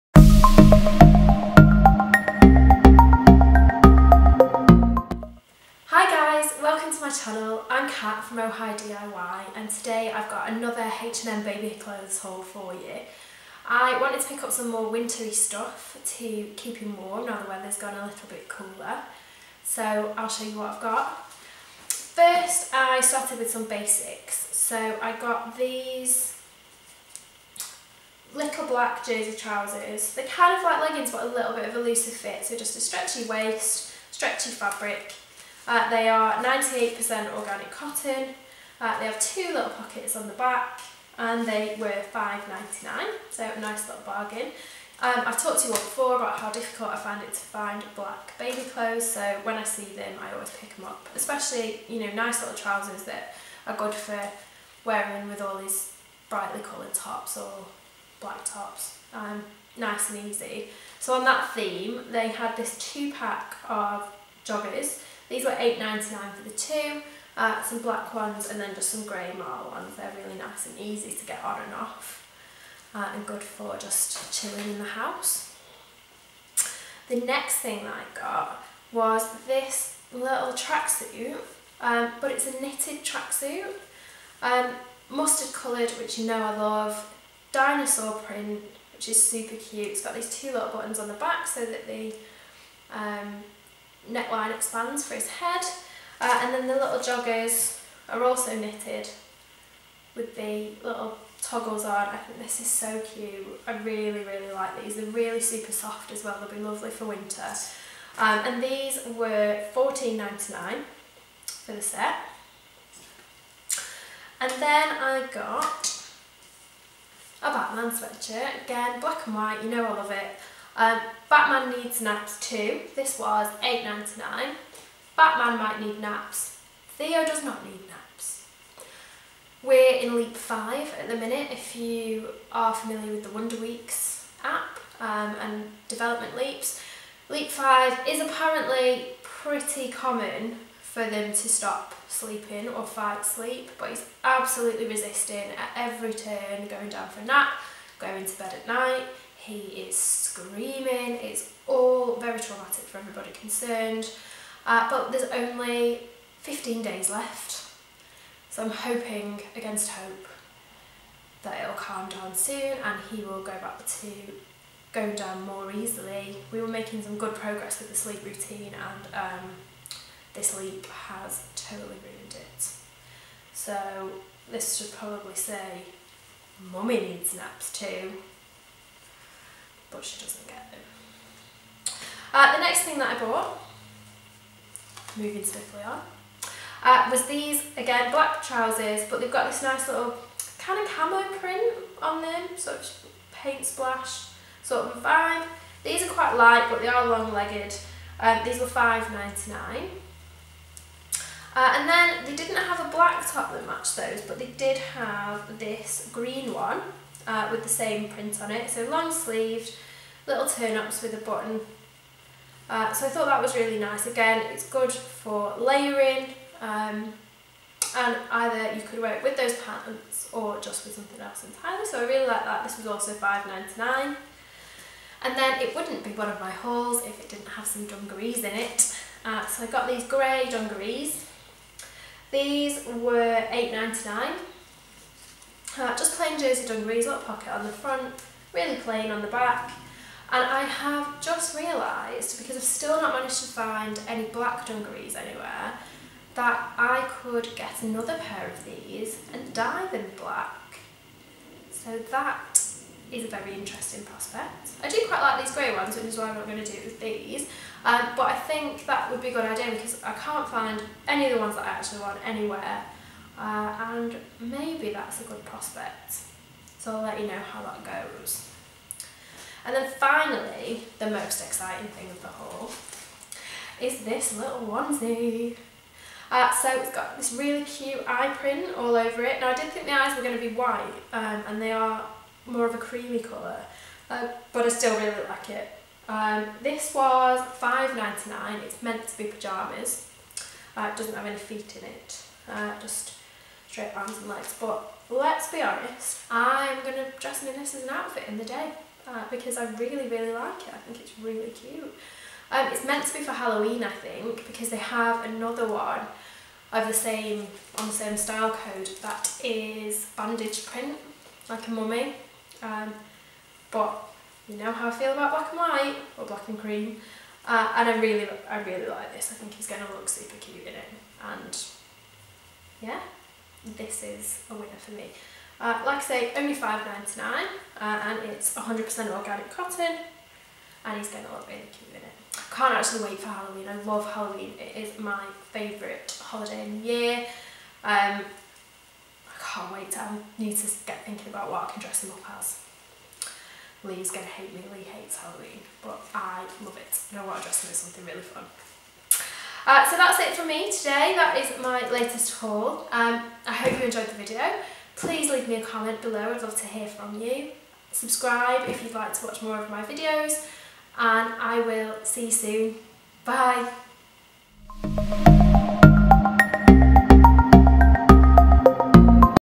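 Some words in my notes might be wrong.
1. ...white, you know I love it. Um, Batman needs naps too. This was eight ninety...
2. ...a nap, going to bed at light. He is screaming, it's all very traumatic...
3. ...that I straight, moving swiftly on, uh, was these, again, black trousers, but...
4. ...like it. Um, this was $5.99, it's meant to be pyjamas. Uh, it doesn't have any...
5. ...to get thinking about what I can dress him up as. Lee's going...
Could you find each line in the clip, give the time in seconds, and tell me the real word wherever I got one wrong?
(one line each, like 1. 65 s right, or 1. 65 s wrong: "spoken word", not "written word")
1. 119 s right
2. 147 s wrong: "night", not "light"
3. 182 s wrong: "bought", not "straight"
4. 285 s right
5. 340 s right.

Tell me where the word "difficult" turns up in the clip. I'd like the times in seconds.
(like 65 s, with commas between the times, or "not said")
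46 s.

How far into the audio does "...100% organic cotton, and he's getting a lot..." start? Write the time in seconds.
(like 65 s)
328 s.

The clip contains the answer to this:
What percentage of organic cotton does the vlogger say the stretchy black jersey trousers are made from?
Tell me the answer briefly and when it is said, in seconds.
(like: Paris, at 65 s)
98%, at 36 s.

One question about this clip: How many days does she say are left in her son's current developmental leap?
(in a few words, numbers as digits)
15.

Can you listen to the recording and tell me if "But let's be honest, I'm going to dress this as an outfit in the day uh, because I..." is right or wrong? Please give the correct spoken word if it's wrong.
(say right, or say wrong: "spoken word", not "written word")
right.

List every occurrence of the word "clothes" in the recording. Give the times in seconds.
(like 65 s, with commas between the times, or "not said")
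11 s, 48 s.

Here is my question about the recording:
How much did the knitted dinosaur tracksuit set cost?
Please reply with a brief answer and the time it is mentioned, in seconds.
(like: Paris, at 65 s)
$14.99, at 109 s.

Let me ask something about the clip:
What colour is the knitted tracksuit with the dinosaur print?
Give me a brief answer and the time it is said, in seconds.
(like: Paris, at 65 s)
Mustard, at 85 s.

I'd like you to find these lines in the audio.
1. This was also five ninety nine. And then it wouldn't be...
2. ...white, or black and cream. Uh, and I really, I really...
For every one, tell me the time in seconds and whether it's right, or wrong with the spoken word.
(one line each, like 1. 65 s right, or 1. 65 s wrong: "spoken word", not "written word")
1. 222 s right
2. 315 s right.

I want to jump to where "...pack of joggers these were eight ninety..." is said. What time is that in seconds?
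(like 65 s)
63 s.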